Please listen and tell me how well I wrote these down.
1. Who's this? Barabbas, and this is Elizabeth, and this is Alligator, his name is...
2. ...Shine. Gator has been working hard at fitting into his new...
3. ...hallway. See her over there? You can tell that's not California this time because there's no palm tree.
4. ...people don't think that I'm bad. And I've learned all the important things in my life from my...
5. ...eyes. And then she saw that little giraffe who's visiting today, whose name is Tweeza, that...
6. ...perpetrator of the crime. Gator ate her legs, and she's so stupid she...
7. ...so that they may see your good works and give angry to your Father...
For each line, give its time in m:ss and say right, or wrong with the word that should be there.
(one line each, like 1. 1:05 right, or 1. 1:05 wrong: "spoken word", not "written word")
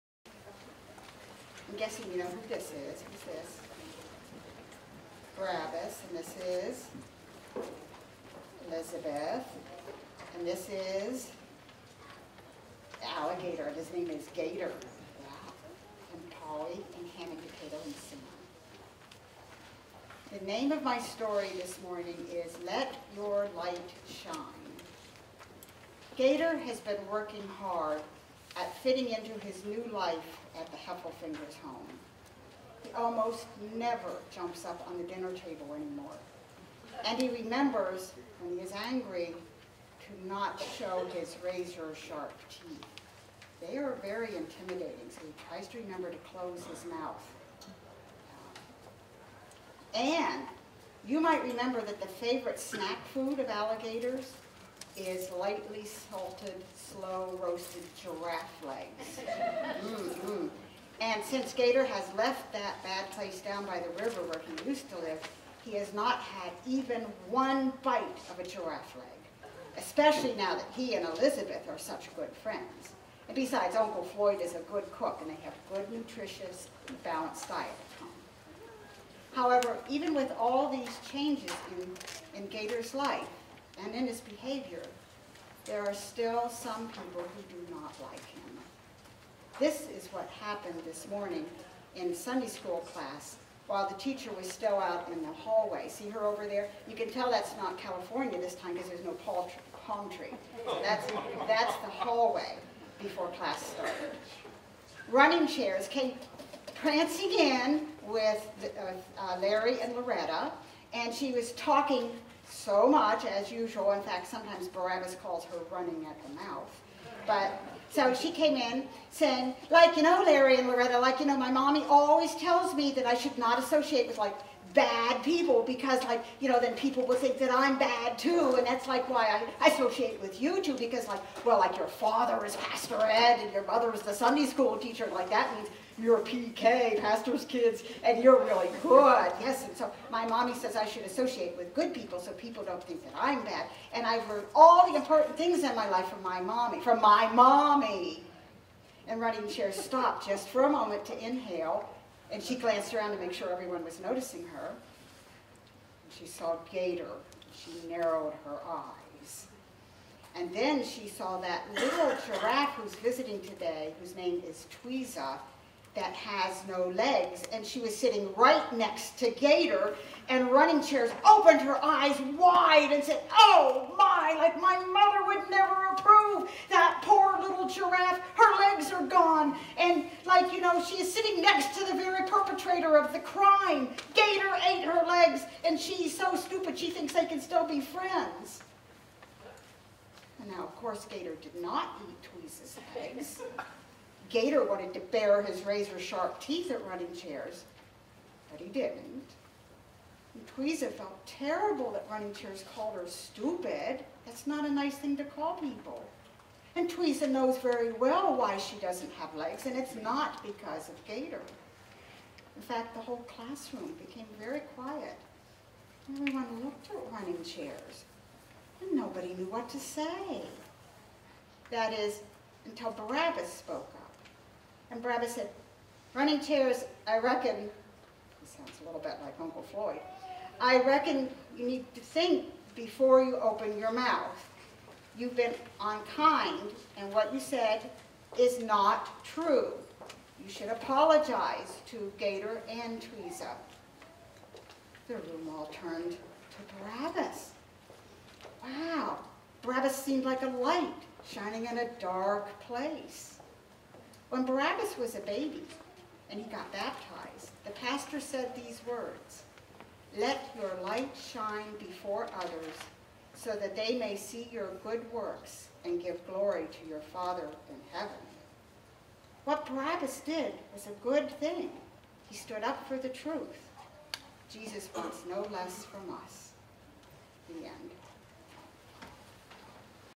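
1. 0:03 right
2. 0:24 right
3. 1:35 right
4. 2:22 right
5. 2:38 right
6. 3:02 right
7. 4:23 wrong: "glory", not "angry".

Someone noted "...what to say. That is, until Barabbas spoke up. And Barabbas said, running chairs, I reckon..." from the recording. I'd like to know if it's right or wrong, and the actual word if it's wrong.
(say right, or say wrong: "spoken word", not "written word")
right.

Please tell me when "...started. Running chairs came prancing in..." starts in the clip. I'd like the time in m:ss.
1:43.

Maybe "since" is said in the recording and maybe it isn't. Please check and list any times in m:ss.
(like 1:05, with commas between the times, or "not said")
1:01.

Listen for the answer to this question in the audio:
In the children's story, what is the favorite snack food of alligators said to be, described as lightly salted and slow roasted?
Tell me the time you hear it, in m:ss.
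0:58.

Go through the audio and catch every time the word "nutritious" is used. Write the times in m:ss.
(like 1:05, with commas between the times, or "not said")
1:15.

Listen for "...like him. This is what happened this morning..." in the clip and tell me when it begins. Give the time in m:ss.
1:28.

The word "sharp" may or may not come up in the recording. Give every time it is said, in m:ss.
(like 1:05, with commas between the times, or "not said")
0:41, 3:15.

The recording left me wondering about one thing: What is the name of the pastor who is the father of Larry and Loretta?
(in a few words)
Pastor Ed.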